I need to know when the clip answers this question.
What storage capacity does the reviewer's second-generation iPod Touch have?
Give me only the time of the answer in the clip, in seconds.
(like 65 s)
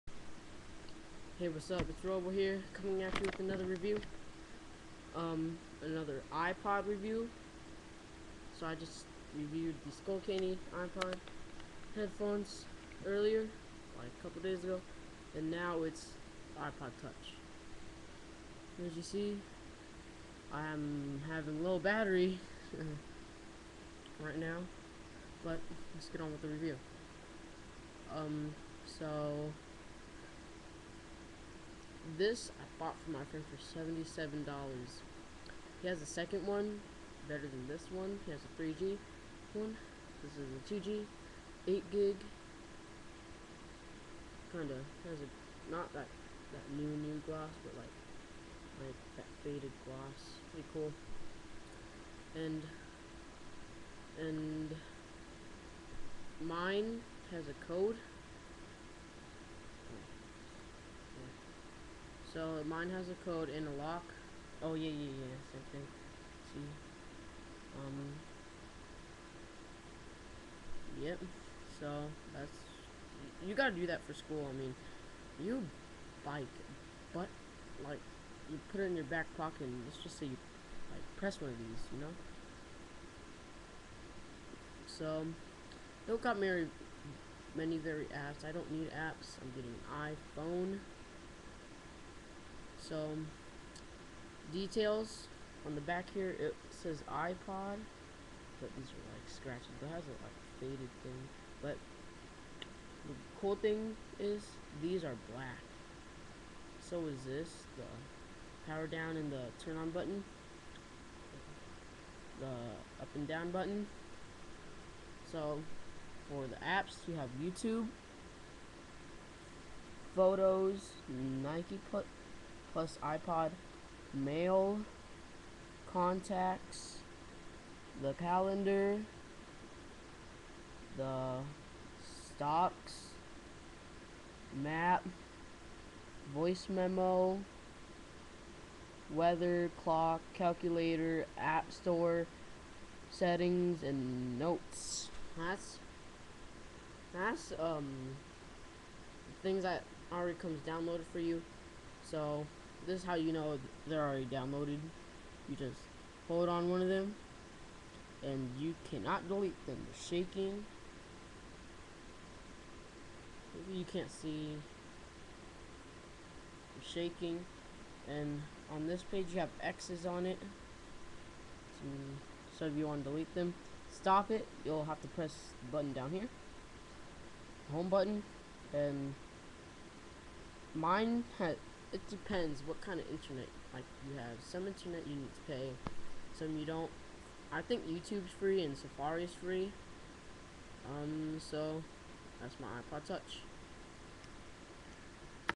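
41 s.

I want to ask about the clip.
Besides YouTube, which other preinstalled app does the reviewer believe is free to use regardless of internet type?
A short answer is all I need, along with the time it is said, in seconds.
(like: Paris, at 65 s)
Safari, at 188 s.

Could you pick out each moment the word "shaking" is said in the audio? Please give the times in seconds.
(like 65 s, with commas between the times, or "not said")
160 s, 167 s.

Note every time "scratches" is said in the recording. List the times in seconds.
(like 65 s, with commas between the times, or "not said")
99 s.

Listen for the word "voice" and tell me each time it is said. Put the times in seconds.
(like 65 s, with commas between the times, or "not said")
136 s.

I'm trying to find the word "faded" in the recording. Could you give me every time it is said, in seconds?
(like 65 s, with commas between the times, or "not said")
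49 s, 100 s.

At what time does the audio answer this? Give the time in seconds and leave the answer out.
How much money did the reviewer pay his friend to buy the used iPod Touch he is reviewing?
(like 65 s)
33 s.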